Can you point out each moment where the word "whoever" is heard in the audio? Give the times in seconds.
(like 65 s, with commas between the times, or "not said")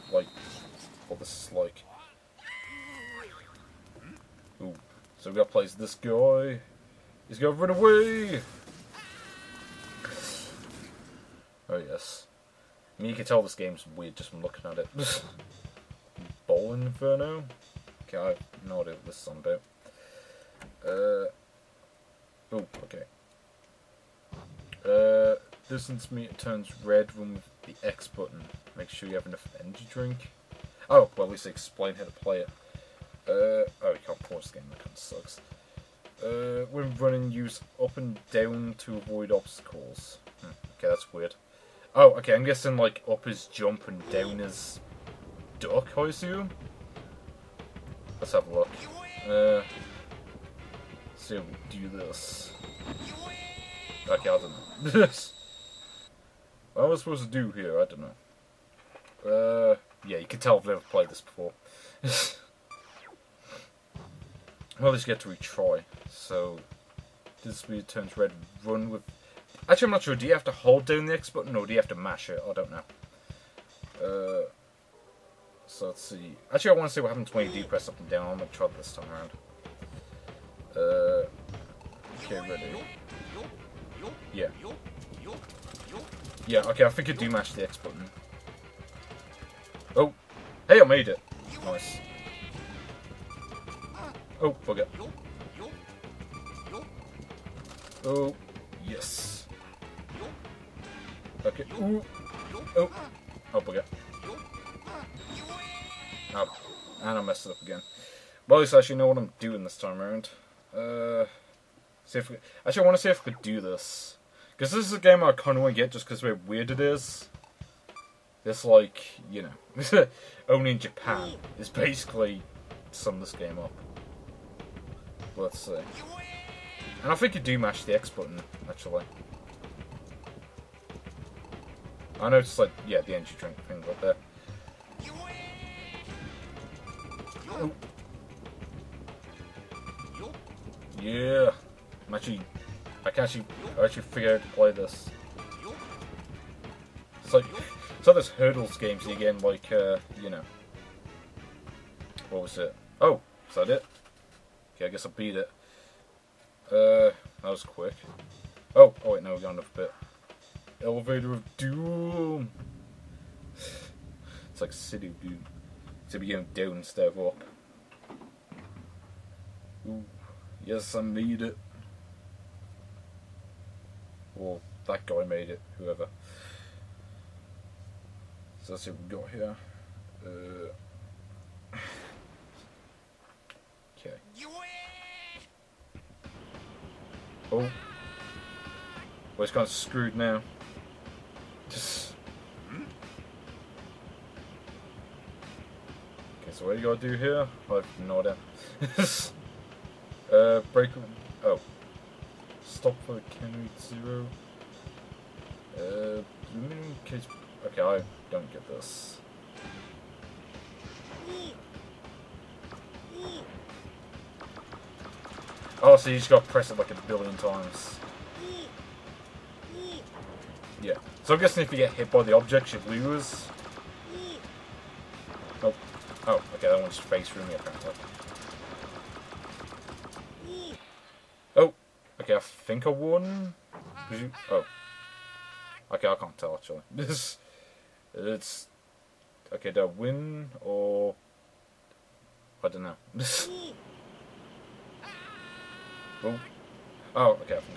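175 s.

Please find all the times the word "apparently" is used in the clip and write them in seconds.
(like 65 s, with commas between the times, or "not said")
227 s.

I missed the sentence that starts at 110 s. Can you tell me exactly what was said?
Uh, see if we, actually, I want to see if we could do this.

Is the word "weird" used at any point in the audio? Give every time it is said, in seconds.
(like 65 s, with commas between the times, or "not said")
13 s, 41 s, 67 s, 116 s.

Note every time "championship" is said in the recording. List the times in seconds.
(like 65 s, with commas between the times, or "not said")
not said.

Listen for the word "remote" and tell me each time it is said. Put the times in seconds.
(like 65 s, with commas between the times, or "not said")
not said.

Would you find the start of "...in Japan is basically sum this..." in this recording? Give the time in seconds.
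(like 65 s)
120 s.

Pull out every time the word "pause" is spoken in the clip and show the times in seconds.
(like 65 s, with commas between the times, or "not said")
34 s.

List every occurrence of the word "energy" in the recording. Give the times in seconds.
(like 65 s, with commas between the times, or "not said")
29 s, 133 s.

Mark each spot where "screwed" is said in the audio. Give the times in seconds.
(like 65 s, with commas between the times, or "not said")
189 s.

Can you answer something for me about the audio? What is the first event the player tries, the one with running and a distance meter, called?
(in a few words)
Bowl Inferno.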